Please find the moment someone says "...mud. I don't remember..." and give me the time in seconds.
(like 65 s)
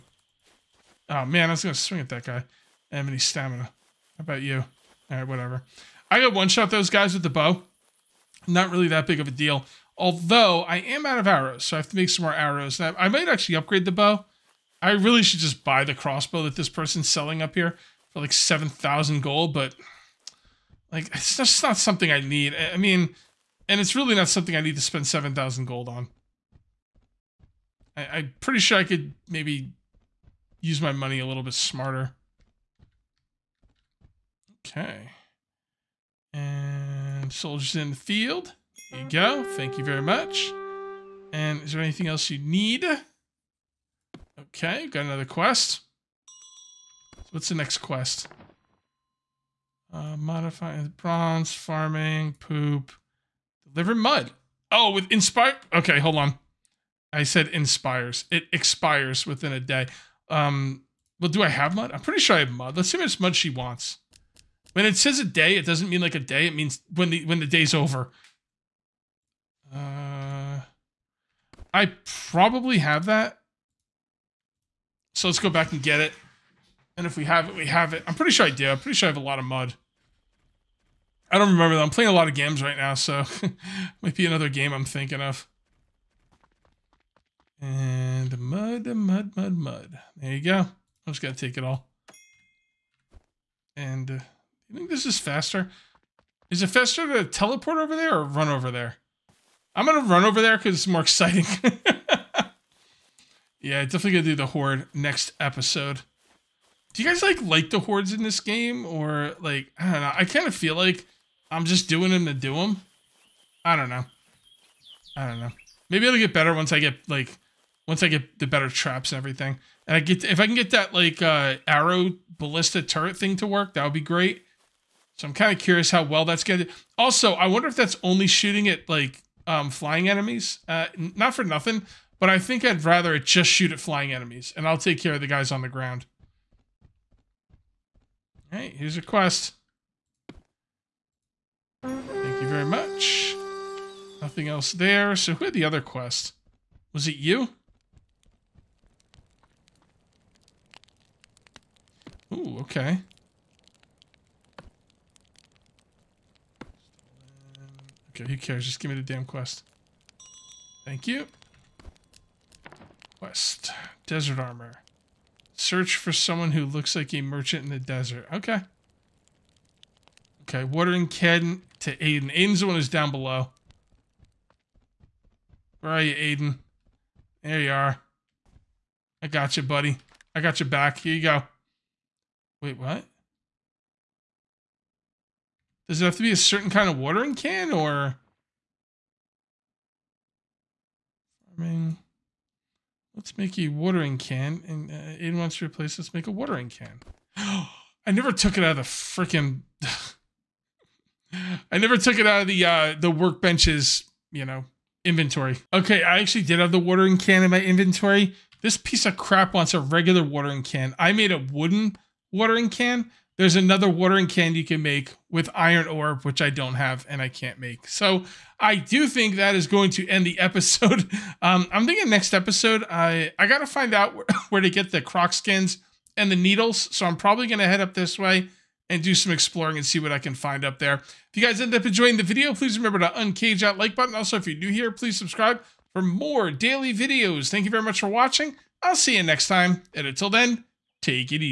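79 s.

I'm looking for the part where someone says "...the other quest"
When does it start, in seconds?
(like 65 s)
145 s.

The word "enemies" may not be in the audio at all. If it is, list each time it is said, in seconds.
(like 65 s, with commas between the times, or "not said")
130 s, 134 s.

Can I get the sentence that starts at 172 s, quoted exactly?
Aiden's the one who's down below.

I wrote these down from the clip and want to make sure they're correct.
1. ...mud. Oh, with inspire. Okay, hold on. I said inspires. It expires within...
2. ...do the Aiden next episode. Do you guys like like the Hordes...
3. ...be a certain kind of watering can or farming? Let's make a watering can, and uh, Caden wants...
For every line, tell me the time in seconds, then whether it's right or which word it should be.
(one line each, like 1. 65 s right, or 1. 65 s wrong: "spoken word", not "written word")
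1. 53 s right
2. 104 s wrong: "Horde", not "Aiden"
3. 186 s wrong: "Aiden", not "Caden".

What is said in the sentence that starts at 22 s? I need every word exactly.
I mean, and it's really not something I need to spend 7,000 gold on.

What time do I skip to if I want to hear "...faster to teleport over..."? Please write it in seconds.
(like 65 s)
96 s.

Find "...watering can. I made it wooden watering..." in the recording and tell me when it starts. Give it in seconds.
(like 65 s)
210 s.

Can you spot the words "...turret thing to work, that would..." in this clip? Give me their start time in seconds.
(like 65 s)
122 s.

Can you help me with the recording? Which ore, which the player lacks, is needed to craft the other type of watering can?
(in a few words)
Iron ore.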